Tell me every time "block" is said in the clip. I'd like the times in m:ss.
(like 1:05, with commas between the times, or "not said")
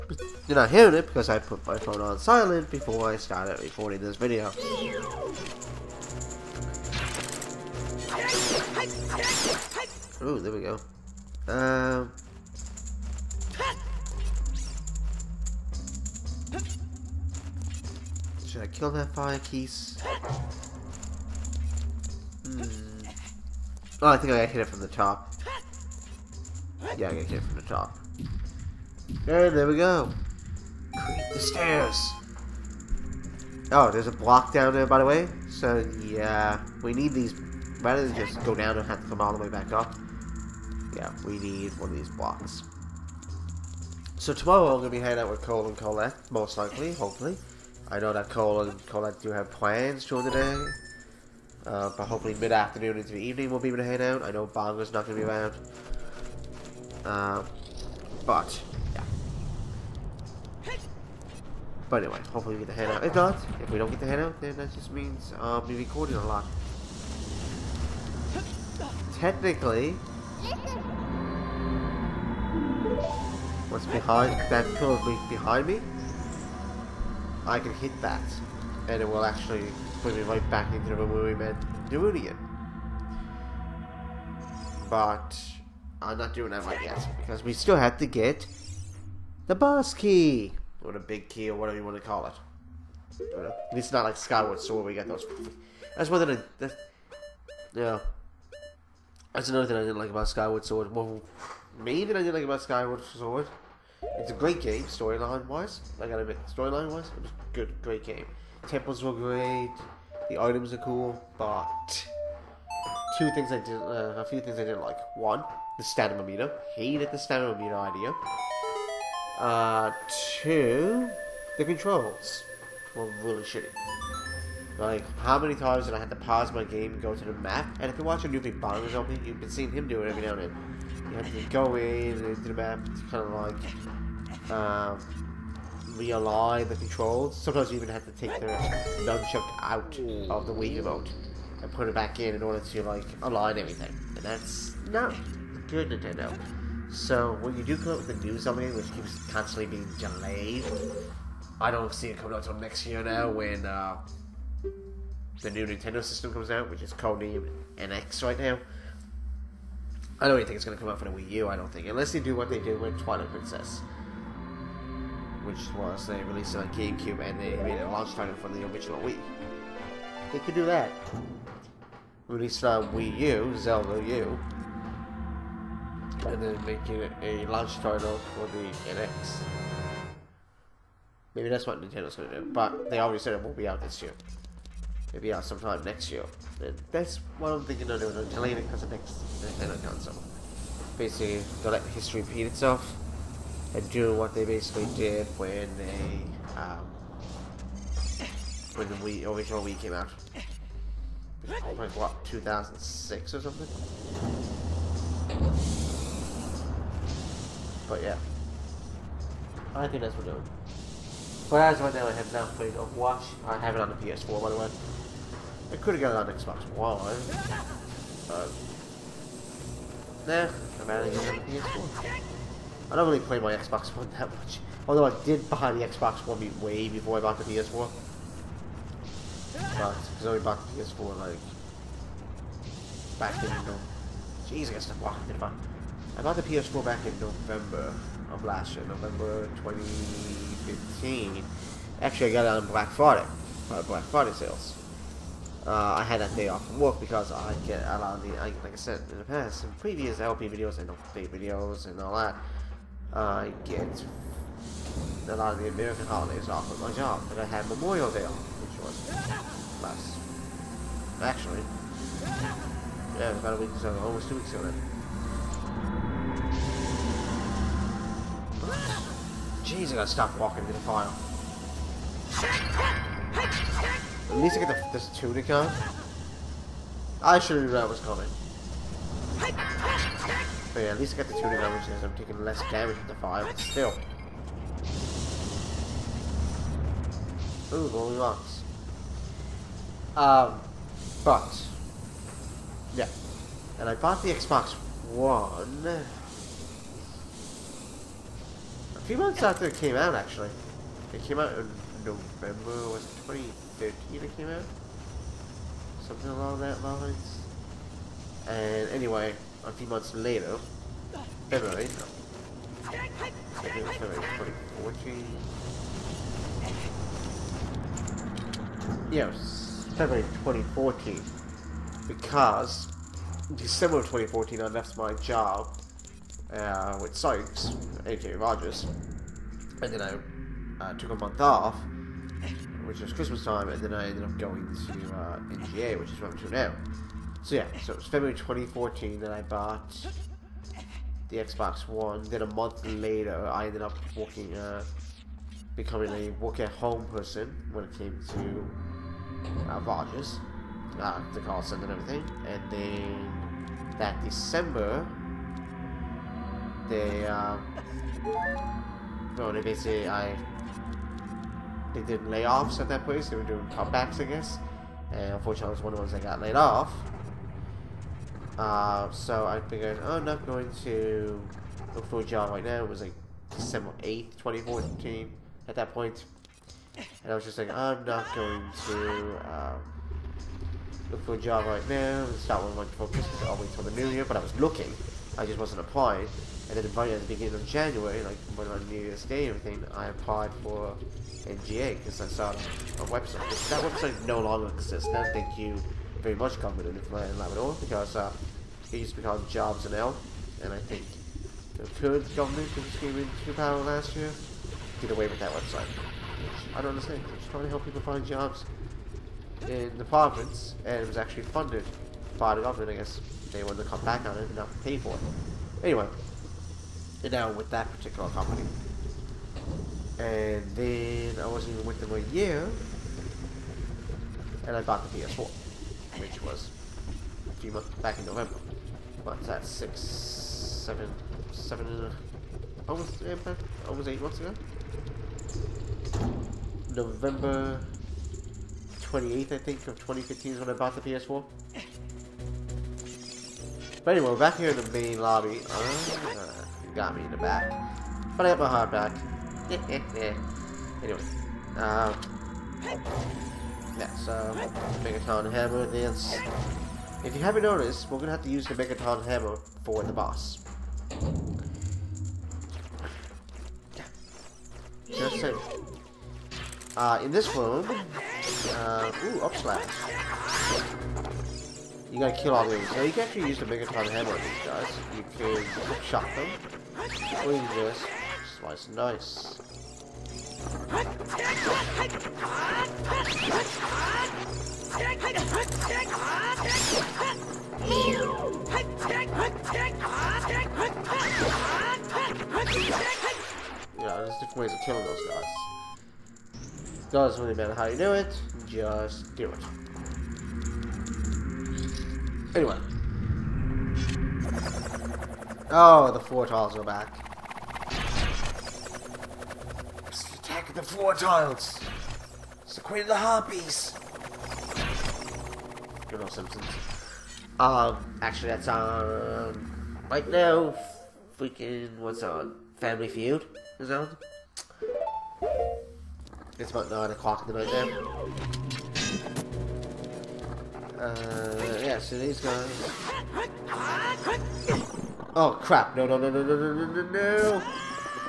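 0:34, 0:42.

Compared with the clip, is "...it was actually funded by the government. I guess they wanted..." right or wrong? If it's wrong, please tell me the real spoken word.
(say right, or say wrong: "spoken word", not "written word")
right.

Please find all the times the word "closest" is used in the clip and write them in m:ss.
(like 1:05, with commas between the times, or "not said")
not said.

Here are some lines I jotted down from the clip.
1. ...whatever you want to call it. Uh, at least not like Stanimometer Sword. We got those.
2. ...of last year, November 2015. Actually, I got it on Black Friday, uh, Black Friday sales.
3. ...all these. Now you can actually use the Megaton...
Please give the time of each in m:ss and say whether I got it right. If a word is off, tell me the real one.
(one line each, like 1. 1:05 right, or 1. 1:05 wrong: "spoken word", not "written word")
1. 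1:31 wrong: "Skyward", not "Stanimometer"
2. 3:58 right
3. 7:52 right.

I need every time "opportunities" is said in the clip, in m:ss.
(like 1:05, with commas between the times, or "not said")
not said.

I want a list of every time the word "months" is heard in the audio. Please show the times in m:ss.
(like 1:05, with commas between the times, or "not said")
4:59, 5:09, 5:31, 5:42, 7:07, 7:14.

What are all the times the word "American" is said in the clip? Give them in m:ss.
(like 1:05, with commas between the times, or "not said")
4:15.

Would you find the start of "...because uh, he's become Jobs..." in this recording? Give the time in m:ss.
6:37.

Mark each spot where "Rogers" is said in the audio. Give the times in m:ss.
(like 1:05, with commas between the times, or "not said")
5:28, 5:49.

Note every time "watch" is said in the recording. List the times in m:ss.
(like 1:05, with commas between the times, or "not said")
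2:08, 3:32.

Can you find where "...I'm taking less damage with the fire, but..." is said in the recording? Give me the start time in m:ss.
4:42.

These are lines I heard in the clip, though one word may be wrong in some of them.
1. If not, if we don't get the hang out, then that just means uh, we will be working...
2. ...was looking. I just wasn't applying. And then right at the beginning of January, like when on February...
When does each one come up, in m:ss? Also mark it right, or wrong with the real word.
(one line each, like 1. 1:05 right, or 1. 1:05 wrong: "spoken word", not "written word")
1. 1:03 wrong: "recording", not "working"
2. 6:24 wrong: "New", not "February".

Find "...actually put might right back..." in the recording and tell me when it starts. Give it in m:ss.
1:19.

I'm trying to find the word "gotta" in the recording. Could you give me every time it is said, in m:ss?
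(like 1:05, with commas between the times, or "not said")
1:46, 4:29, 7:52.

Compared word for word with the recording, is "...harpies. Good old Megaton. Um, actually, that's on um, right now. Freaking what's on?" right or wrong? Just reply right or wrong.
wrong.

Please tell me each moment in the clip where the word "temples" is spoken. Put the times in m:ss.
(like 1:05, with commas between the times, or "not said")
1:48.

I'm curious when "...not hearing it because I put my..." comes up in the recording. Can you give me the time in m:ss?
0:00.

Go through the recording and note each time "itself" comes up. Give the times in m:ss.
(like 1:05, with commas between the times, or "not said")
3:12.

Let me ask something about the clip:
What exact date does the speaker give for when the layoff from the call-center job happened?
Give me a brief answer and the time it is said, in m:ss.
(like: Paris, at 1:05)
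December 8th, 2014, at 6:13.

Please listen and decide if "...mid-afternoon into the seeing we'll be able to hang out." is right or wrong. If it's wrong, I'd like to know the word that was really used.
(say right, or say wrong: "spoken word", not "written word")
wrong: "evening", not "seeing".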